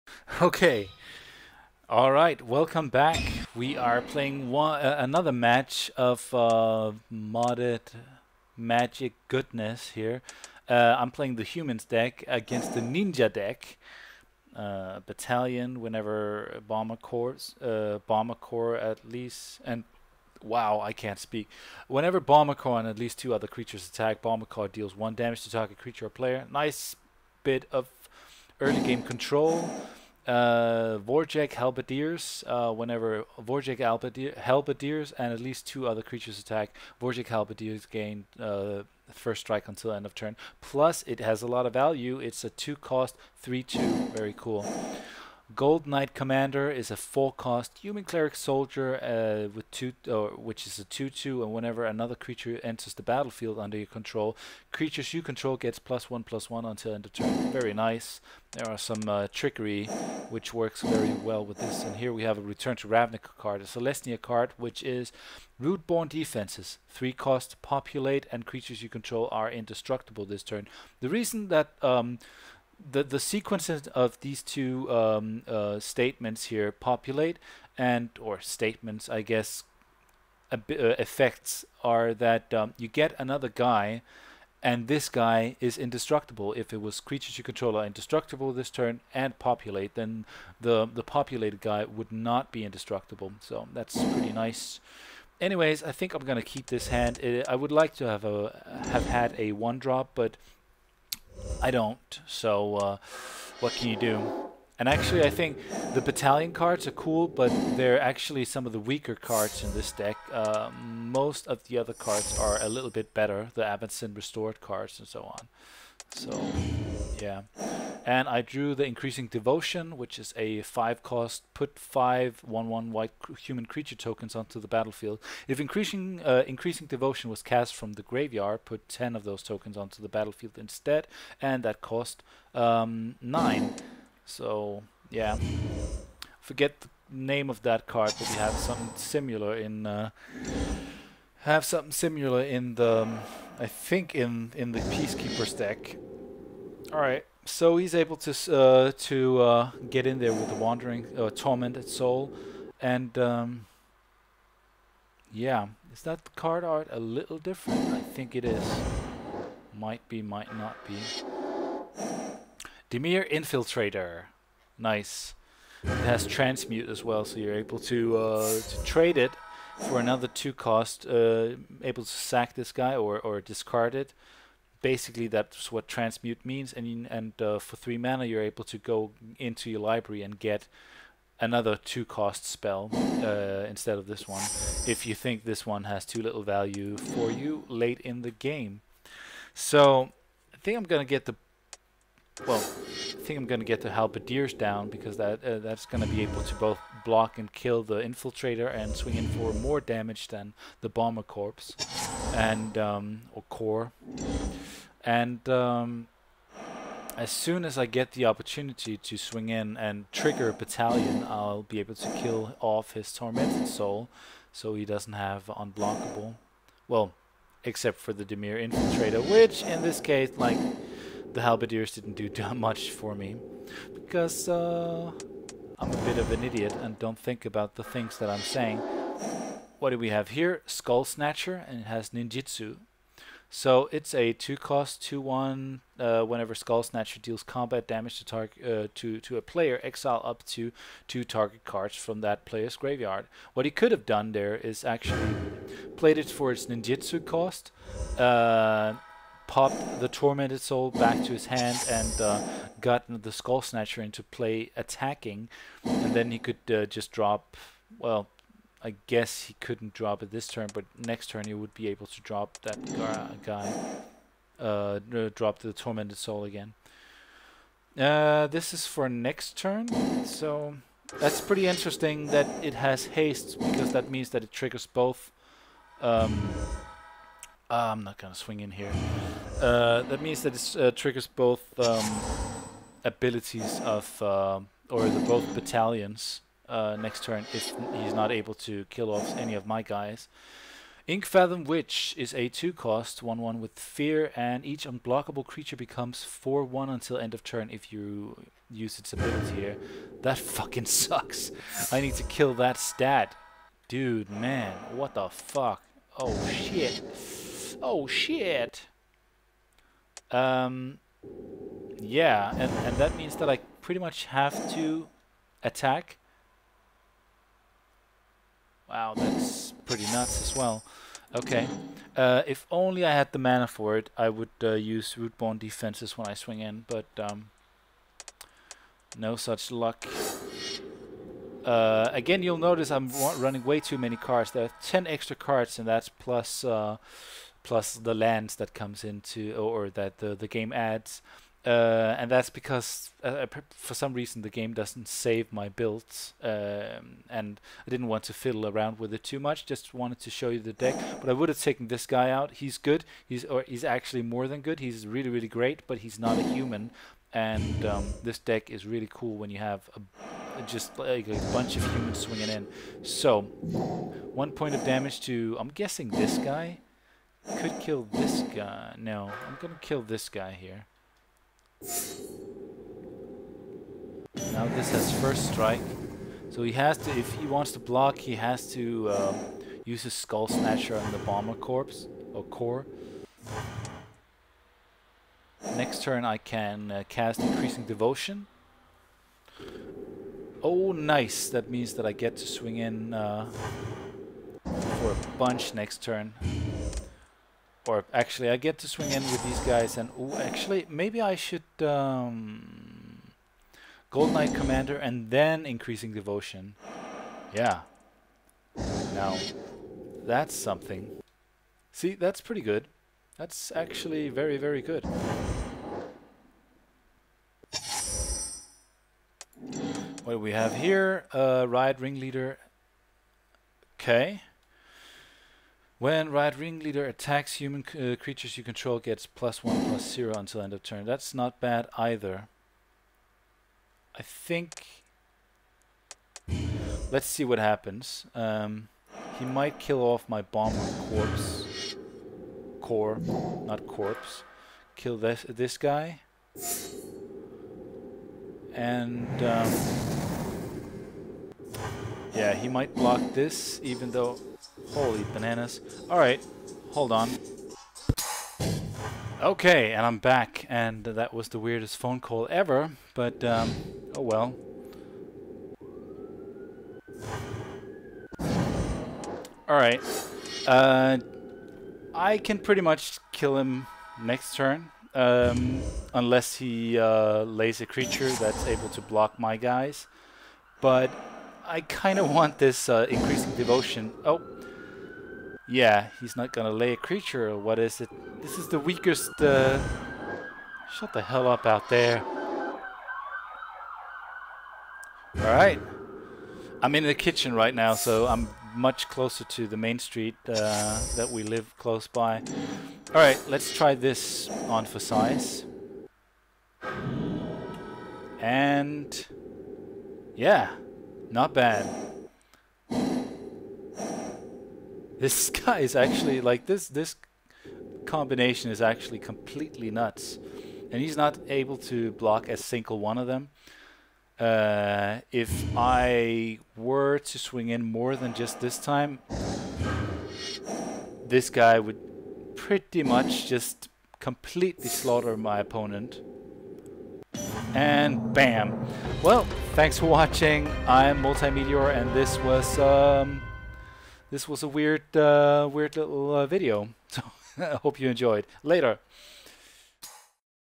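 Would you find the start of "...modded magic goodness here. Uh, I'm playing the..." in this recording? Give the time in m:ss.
0:07.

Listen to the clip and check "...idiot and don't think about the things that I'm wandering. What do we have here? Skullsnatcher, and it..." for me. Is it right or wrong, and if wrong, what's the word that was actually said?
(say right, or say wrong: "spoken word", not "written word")
wrong: "saying", not "wandering".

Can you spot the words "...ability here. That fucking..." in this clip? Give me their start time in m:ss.
4:59.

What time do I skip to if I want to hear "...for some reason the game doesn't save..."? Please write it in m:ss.
5:43.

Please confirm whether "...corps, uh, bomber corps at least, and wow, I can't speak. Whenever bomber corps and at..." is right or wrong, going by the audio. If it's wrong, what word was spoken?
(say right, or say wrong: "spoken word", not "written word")
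right.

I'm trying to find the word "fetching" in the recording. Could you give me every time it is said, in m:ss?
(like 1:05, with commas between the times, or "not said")
not said.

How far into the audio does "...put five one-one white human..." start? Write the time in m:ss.
2:01.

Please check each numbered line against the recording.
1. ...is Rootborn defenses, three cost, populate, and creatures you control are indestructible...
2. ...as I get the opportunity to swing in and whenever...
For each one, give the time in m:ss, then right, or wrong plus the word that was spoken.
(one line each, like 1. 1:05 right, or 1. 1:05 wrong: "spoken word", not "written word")
1. 1:04 right
2. 3:27 wrong: "trigger", not "whenever".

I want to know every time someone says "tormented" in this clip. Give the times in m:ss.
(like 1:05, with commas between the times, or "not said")
2:31, 3:33, 4:10, 4:25.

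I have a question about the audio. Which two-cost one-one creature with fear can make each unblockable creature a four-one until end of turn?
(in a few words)
Inkfathom Witch.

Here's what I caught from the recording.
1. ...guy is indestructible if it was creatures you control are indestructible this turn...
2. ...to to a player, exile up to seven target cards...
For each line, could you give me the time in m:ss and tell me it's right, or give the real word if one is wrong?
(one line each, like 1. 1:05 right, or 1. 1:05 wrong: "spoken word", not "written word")
1. 1:25 right
2. 3:58 wrong: "two", not "seven".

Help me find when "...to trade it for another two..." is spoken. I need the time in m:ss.
2:48.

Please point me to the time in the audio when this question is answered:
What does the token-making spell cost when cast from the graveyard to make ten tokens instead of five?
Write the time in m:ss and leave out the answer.
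2:13.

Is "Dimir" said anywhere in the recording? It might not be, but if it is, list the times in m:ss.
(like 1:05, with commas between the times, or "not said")
2:42, 3:38.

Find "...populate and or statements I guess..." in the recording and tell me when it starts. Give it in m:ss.
1:16.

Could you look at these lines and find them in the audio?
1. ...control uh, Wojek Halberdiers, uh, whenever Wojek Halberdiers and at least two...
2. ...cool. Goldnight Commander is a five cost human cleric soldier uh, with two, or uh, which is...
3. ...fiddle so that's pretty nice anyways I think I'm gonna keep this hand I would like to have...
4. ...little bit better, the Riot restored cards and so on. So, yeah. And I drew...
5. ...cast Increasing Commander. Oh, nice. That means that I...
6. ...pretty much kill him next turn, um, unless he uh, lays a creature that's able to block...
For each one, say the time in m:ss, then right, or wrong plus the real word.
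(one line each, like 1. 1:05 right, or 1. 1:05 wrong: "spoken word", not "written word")
1. 0:29 right
2. 0:44 wrong: "four", not "five"
3. 1:32 wrong: "indestructible", not "fiddle"
4. 1:52 wrong: "Avacyn", not "Riot"
5. 6:27 wrong: "Devotion", not "Commander"
6. 7:52 right.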